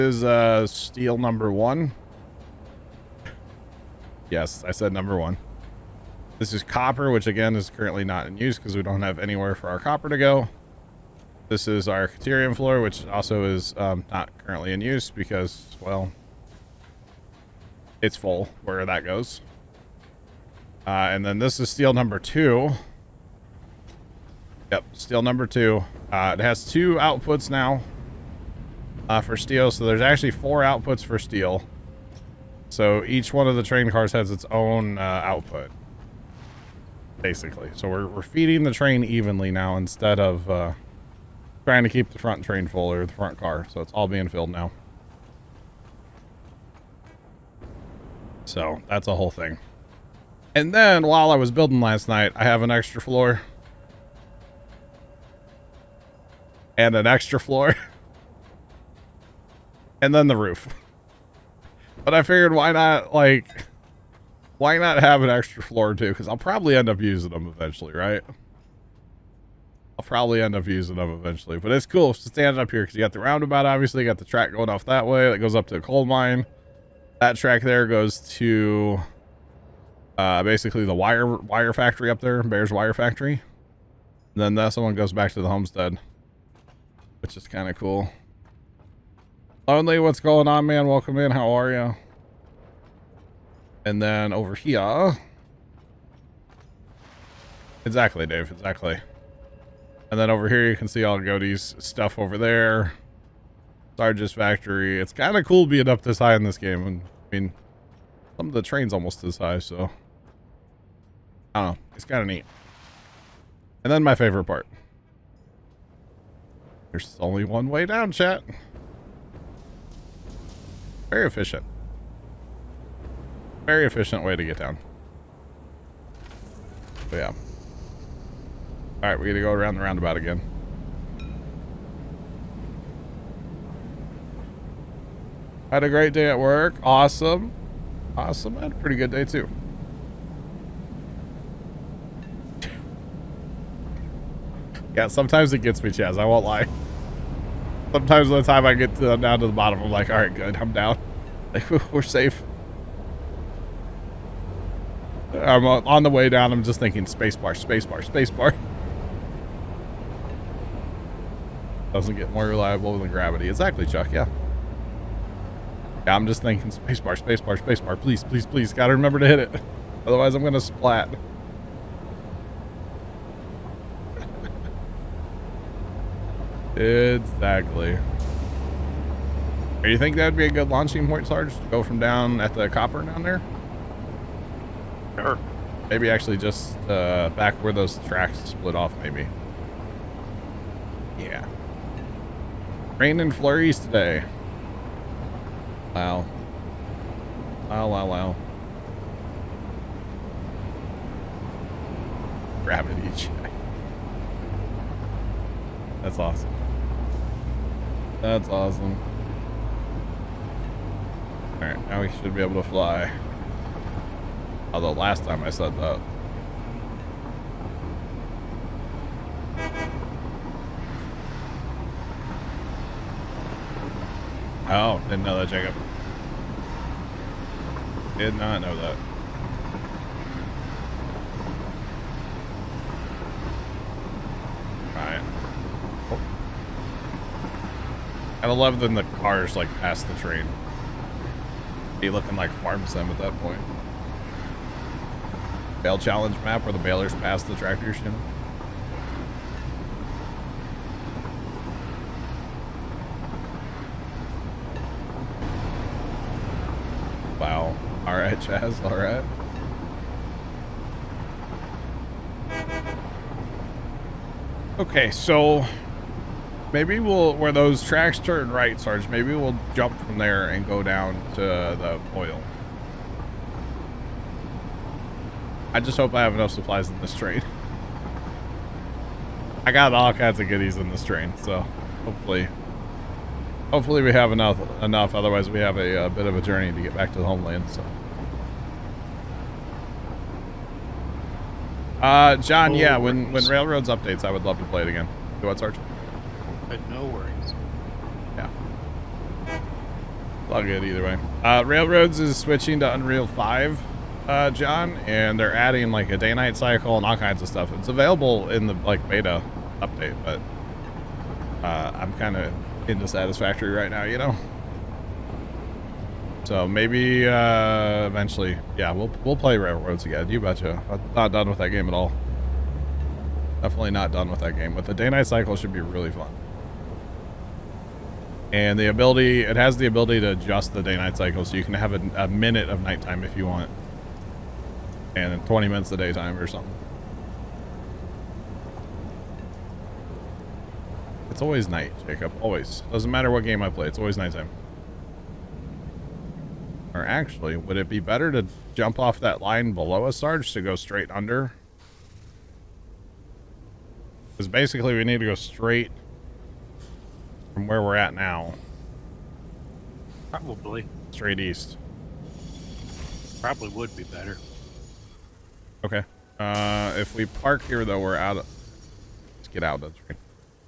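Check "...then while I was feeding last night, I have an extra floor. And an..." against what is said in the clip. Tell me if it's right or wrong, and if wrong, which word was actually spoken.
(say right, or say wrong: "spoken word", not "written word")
wrong: "building", not "feeding".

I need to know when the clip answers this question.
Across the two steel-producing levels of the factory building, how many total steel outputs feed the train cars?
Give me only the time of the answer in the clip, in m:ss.
0:30.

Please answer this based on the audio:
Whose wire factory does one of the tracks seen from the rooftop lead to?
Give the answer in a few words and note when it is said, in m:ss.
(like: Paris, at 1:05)
Bear's, at 1:22.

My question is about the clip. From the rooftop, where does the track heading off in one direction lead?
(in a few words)
The coal mine.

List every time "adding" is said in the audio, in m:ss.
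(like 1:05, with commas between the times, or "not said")
5:05.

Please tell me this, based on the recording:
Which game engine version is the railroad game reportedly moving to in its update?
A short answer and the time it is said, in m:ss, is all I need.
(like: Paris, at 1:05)
Unreal 5, at 5:02.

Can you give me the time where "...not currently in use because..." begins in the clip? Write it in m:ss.
0:14.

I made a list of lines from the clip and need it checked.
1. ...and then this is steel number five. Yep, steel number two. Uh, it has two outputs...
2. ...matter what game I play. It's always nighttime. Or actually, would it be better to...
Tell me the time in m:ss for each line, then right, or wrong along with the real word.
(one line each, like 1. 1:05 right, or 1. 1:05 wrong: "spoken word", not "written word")
1. 0:21 wrong: "two", not "five"
2. 5:43 right.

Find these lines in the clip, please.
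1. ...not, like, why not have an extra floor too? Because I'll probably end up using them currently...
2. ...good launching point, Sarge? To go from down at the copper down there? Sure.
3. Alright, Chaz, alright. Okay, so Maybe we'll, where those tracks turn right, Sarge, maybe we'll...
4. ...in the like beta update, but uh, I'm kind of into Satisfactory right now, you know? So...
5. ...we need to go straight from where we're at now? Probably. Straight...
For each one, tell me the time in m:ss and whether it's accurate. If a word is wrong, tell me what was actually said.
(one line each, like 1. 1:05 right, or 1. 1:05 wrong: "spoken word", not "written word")
1. 1:02 wrong: "eventually", not "currently"
2. 3:00 right
3. 4:18 right
4. 5:08 right
5. 5:54 right.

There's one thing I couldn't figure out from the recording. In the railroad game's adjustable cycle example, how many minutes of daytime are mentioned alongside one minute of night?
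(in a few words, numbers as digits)
20.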